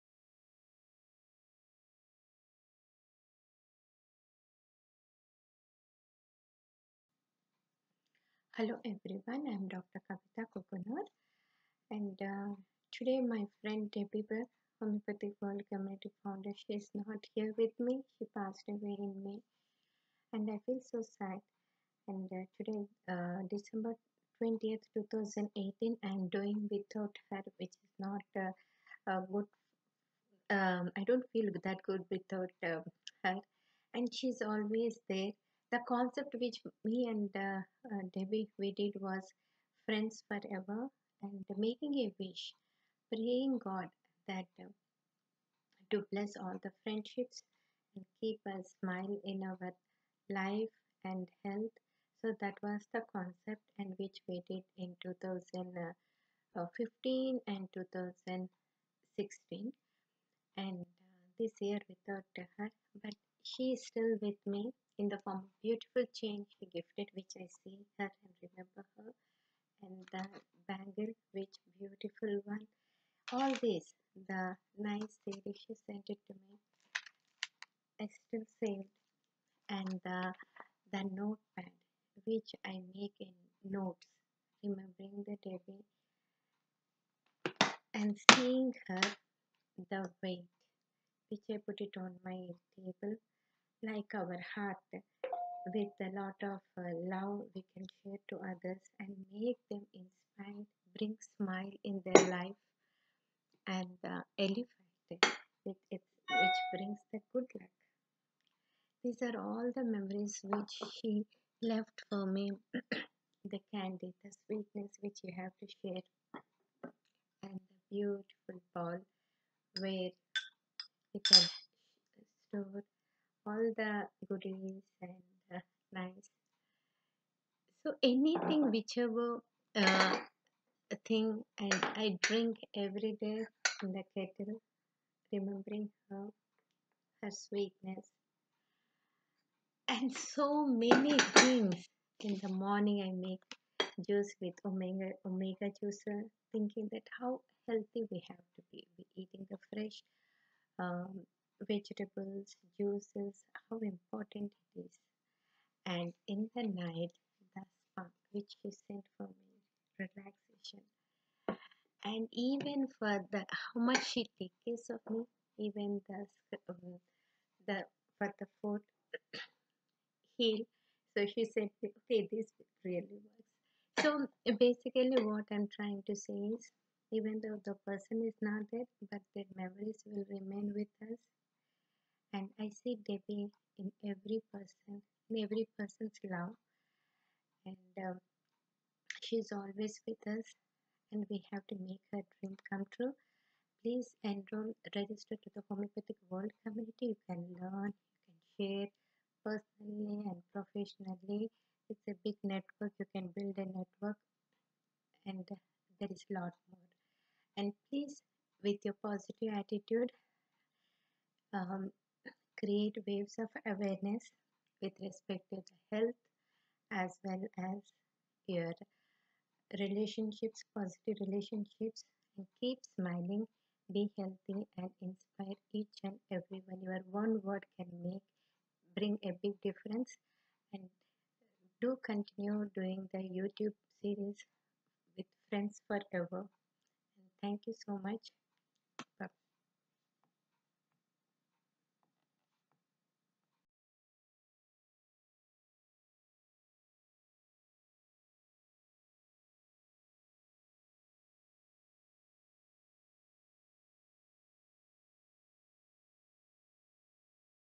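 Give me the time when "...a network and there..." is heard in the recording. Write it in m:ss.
3:23.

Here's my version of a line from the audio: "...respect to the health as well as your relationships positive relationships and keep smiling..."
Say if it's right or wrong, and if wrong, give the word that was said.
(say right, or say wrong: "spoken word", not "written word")
right.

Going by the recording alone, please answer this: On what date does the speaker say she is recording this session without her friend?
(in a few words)
December 20th, 2018.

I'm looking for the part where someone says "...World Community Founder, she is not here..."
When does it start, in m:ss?
0:15.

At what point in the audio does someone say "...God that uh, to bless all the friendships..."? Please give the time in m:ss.
0:43.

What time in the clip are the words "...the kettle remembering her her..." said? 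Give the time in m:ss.
2:13.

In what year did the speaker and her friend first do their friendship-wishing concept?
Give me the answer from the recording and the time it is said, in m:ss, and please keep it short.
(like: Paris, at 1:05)
2015, at 0:55.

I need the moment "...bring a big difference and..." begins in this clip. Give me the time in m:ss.
3:48.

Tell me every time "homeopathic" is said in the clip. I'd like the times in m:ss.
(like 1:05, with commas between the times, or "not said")
0:14, 3:15.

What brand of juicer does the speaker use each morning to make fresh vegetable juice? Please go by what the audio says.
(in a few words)
Omega.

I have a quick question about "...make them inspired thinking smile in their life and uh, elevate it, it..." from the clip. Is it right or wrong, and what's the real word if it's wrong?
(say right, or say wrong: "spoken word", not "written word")
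wrong: "bring", not "thinking".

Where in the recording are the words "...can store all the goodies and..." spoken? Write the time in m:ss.
2:01.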